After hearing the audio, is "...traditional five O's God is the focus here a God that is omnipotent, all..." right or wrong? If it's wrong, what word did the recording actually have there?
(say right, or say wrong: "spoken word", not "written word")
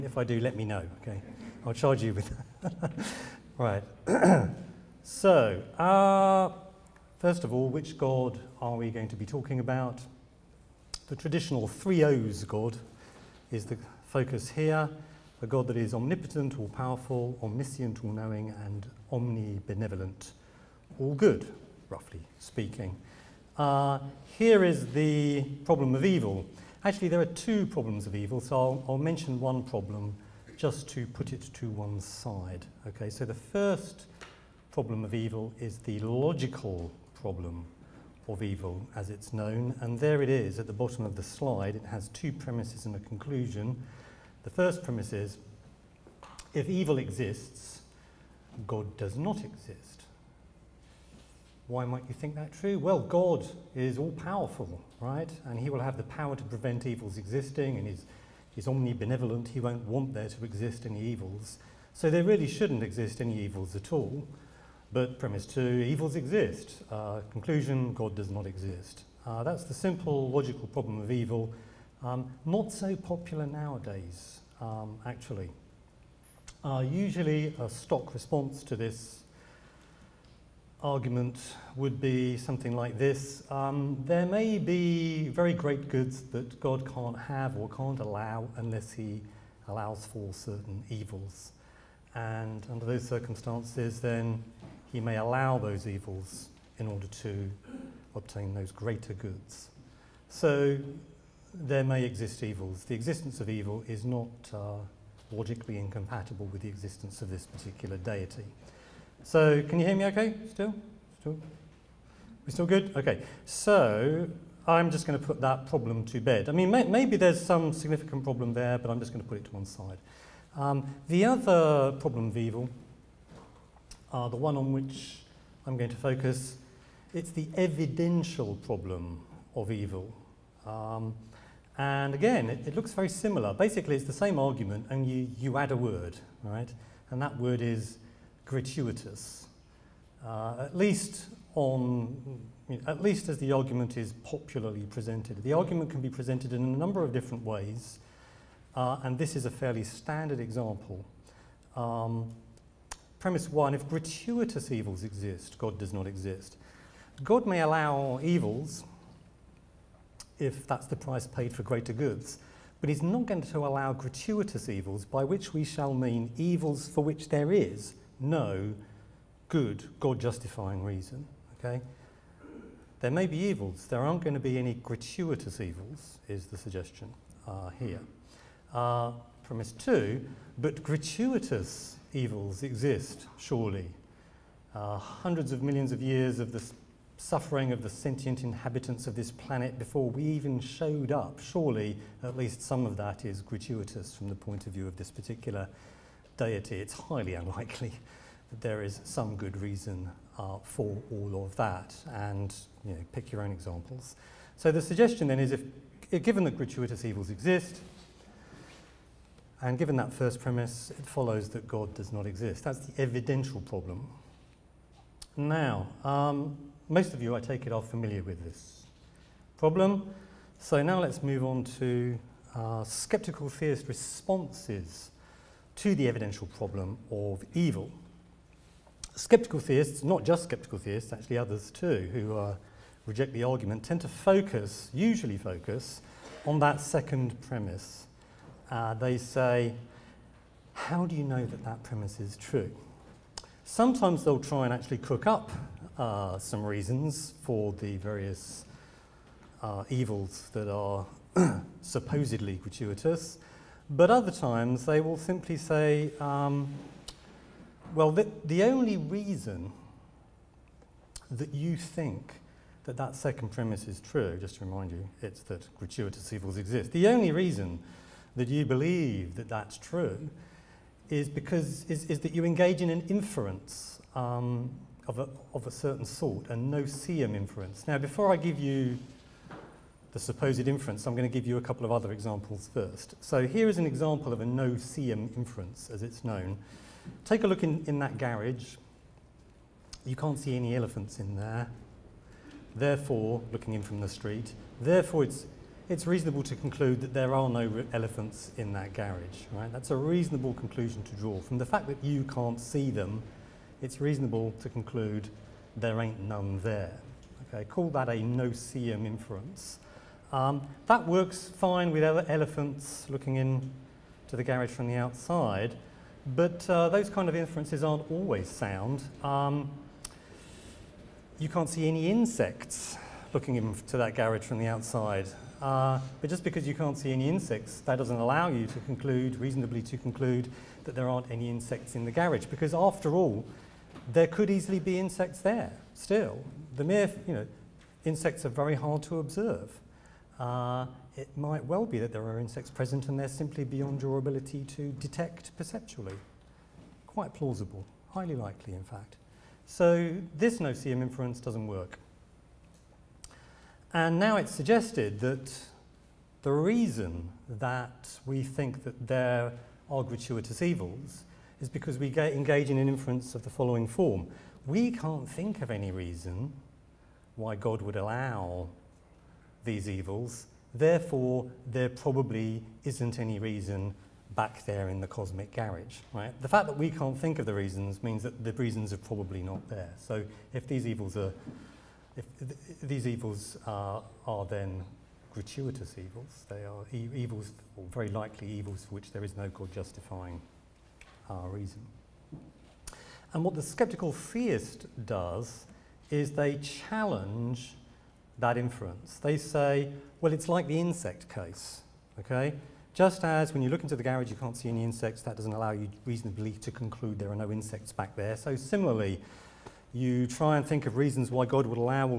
wrong: "three", not "five".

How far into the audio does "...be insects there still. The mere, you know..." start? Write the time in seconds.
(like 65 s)
334 s.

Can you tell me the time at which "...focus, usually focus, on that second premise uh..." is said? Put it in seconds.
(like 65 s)
234 s.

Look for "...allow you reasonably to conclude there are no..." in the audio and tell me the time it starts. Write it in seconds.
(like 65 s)
405 s.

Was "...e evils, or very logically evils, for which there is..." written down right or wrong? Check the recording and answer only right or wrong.
wrong.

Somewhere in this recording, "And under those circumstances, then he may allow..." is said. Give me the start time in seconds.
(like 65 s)
92 s.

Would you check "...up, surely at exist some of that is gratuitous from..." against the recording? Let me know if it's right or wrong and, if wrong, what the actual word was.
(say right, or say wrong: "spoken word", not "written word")
wrong: "least", not "exist".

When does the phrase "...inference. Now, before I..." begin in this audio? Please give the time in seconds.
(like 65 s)
277 s.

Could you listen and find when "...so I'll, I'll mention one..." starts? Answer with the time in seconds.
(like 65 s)
28 s.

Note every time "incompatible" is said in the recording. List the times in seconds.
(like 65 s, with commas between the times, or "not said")
105 s.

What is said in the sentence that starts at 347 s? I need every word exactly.
Quite plausible, highly likely in fact.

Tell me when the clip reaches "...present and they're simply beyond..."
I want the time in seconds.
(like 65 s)
342 s.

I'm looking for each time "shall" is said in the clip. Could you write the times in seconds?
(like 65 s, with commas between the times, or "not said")
165 s.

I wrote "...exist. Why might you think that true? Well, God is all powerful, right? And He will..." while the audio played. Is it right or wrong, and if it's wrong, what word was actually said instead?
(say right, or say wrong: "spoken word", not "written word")
right.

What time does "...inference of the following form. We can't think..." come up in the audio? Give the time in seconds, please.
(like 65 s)
362 s.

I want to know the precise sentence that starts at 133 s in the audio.
Basically, it's the same argument, and you, you add a word, right?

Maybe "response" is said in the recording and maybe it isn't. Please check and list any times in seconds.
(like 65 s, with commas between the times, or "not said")
78 s, 223 s.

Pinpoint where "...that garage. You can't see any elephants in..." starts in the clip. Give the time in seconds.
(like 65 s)
287 s.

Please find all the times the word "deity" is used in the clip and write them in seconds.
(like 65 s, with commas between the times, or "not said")
107 s, 196 s.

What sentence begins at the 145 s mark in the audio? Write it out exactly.
The argument can be presented in a number of different ways.